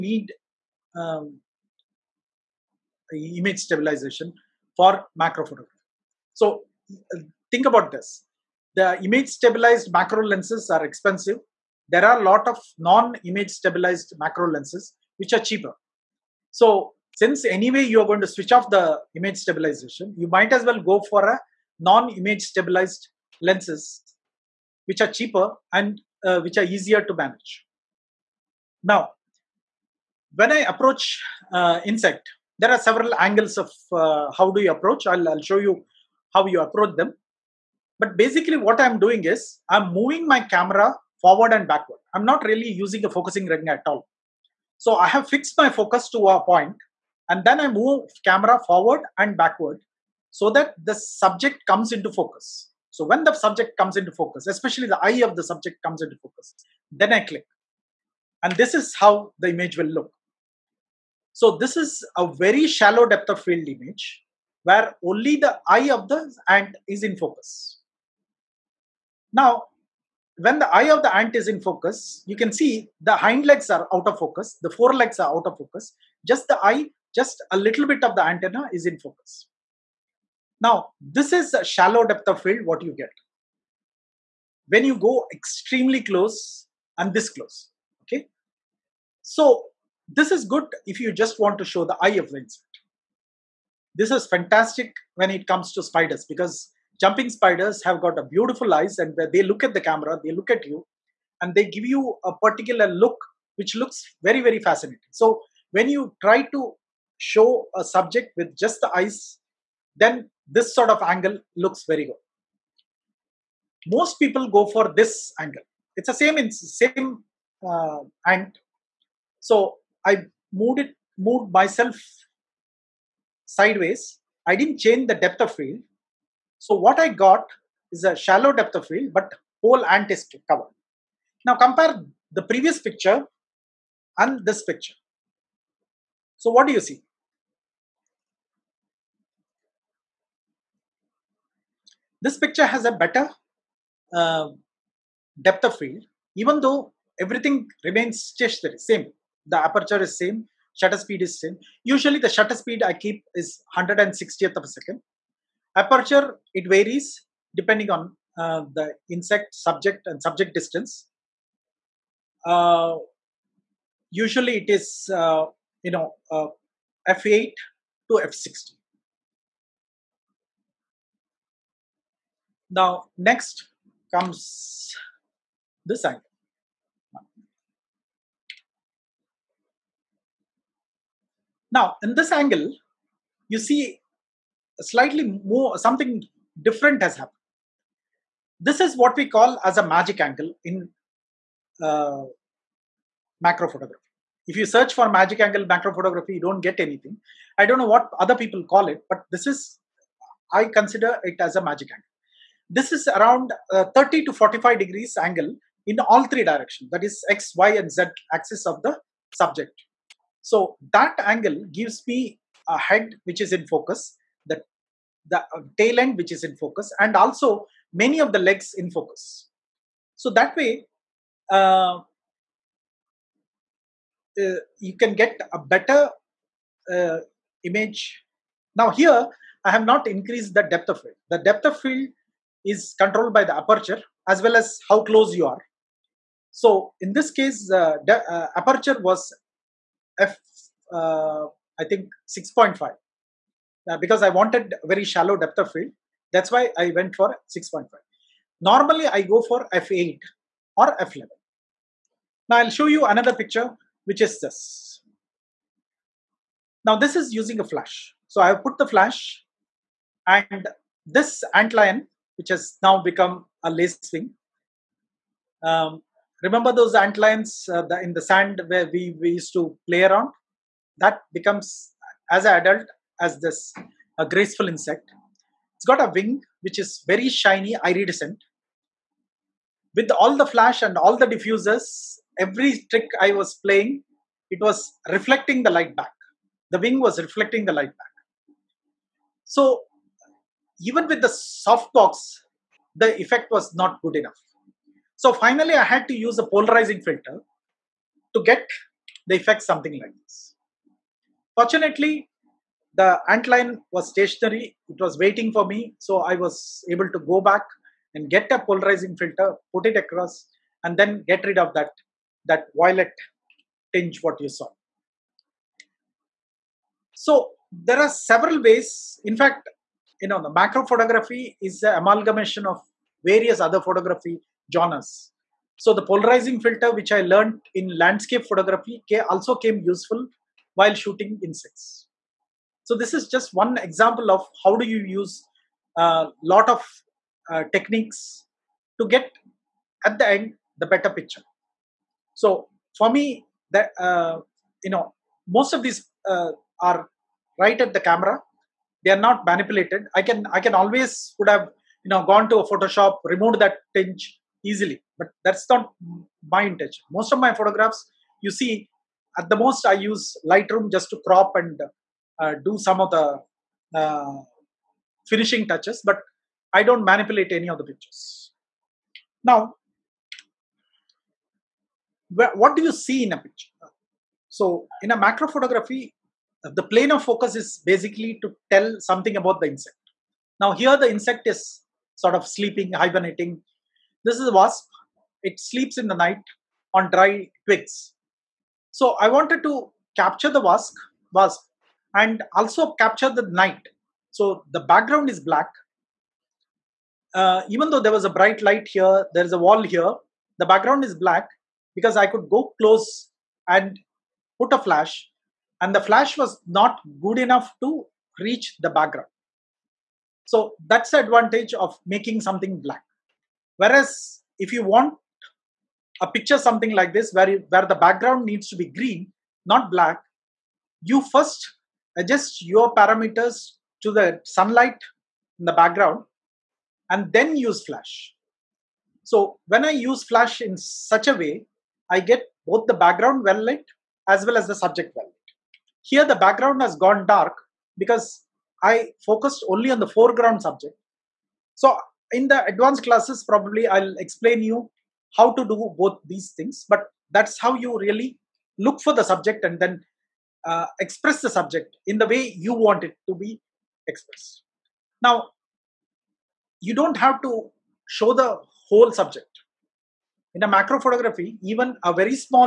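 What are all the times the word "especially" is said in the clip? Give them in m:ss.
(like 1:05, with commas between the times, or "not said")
0:54.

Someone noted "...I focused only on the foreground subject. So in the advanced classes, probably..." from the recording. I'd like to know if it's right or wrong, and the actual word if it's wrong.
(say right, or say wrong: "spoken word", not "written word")
right.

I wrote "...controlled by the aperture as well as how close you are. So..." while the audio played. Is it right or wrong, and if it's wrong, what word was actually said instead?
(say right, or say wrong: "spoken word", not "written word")
right.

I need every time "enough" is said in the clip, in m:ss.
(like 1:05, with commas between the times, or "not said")
4:54, 6:47.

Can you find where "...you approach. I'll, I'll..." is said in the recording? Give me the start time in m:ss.
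0:34.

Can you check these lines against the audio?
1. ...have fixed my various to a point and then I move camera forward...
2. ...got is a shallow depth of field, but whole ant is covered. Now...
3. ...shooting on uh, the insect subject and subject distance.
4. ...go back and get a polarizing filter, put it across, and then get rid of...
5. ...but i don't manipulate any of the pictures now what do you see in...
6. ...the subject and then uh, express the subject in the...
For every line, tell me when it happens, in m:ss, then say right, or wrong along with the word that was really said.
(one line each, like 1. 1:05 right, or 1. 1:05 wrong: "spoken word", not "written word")
1. 0:45 wrong: "focus", not "various"
2. 2:07 right
3. 2:37 wrong: "depending", not "shooting"
4. 5:07 right
5. 6:06 right
6. 7:29 right.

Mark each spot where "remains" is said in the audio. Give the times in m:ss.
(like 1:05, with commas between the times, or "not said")
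2:27.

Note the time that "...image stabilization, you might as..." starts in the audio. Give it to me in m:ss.
0:19.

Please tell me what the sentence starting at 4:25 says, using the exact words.
Um, remember those antlions uh, in the sand where we, we used to play around?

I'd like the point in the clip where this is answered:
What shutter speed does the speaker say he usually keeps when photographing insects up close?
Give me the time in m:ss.
2:33.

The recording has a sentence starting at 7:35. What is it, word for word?
Now, you don't have to show the whole subject.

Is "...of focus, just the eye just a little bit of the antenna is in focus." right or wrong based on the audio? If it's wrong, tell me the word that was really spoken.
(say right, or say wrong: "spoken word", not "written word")
right.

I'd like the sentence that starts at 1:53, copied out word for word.
Most people go for this angle.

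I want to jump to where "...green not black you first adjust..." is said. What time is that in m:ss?
6:58.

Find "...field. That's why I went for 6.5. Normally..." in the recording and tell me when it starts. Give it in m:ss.
4:05.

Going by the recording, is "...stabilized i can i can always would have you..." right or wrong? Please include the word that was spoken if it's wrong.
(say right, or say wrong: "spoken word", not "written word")
wrong: "manipulated", not "stabilized".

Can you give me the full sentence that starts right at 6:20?
Now here the insect is sort of sleeping, hibernating.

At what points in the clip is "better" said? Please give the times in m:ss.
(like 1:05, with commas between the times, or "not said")
2:22, 3:45, 5:40.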